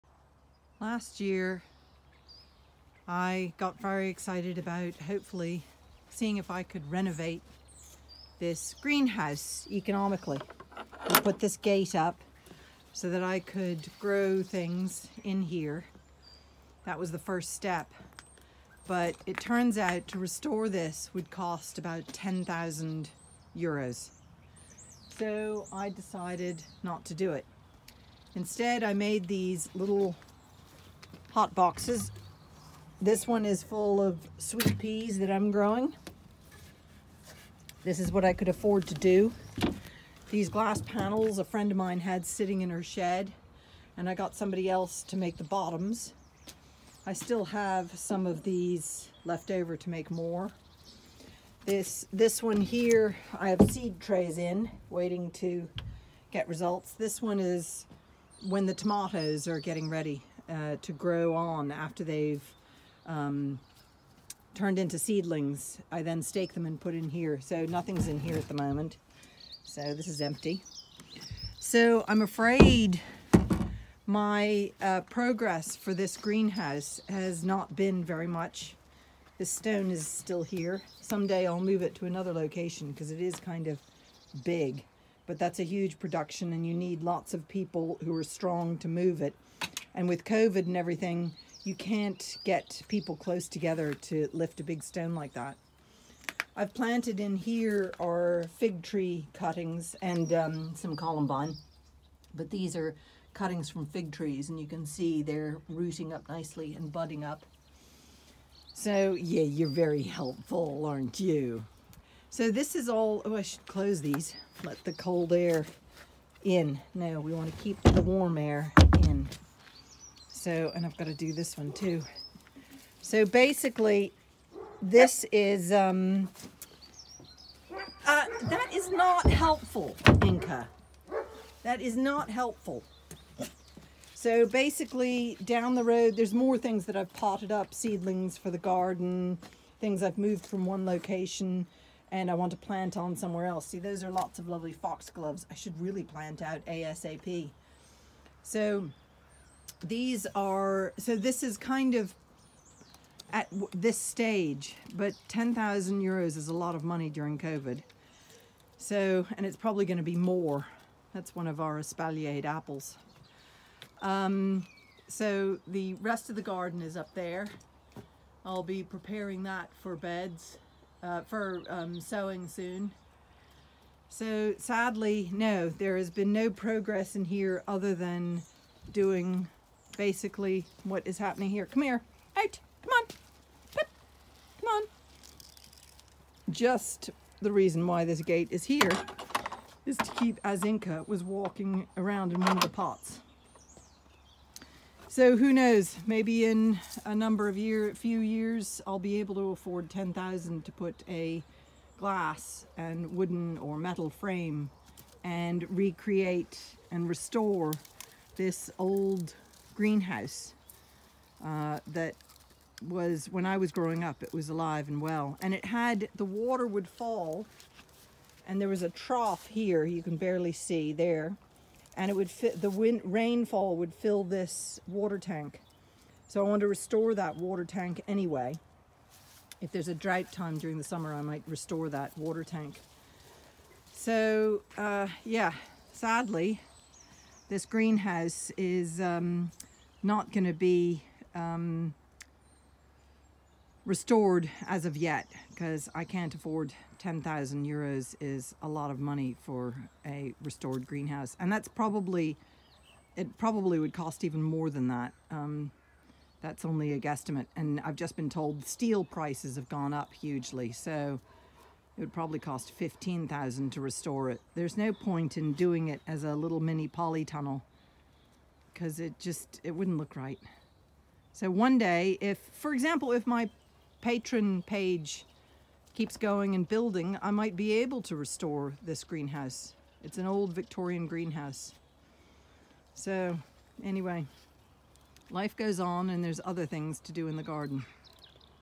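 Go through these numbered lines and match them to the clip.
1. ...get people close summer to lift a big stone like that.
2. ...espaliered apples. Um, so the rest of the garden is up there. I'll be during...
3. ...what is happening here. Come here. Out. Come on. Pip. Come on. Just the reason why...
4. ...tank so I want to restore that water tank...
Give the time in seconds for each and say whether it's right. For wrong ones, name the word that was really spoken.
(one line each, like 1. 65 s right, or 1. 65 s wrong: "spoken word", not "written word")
1. 92 s wrong: "together", not "summer"
2. 161 s wrong: "preparing", not "during"
3. 180 s right
4. 225 s right.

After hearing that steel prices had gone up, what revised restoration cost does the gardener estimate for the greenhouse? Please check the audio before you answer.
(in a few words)
15,000.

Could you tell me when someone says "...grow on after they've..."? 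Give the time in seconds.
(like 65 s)
60 s.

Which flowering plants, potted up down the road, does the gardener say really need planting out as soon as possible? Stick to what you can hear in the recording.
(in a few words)
foxgloves.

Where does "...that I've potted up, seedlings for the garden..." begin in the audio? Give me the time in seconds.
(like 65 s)
136 s.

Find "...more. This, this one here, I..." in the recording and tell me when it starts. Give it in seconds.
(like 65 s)
50 s.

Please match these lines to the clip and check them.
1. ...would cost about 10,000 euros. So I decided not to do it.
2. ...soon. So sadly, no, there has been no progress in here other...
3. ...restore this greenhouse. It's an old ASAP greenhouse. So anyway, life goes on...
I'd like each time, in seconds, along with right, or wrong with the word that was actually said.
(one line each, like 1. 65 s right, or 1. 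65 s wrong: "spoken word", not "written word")
1. 21 s right
2. 172 s right
3. 278 s wrong: "Victorian", not "ASAP".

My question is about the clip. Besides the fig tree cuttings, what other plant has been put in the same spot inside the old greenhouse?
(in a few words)
columbine.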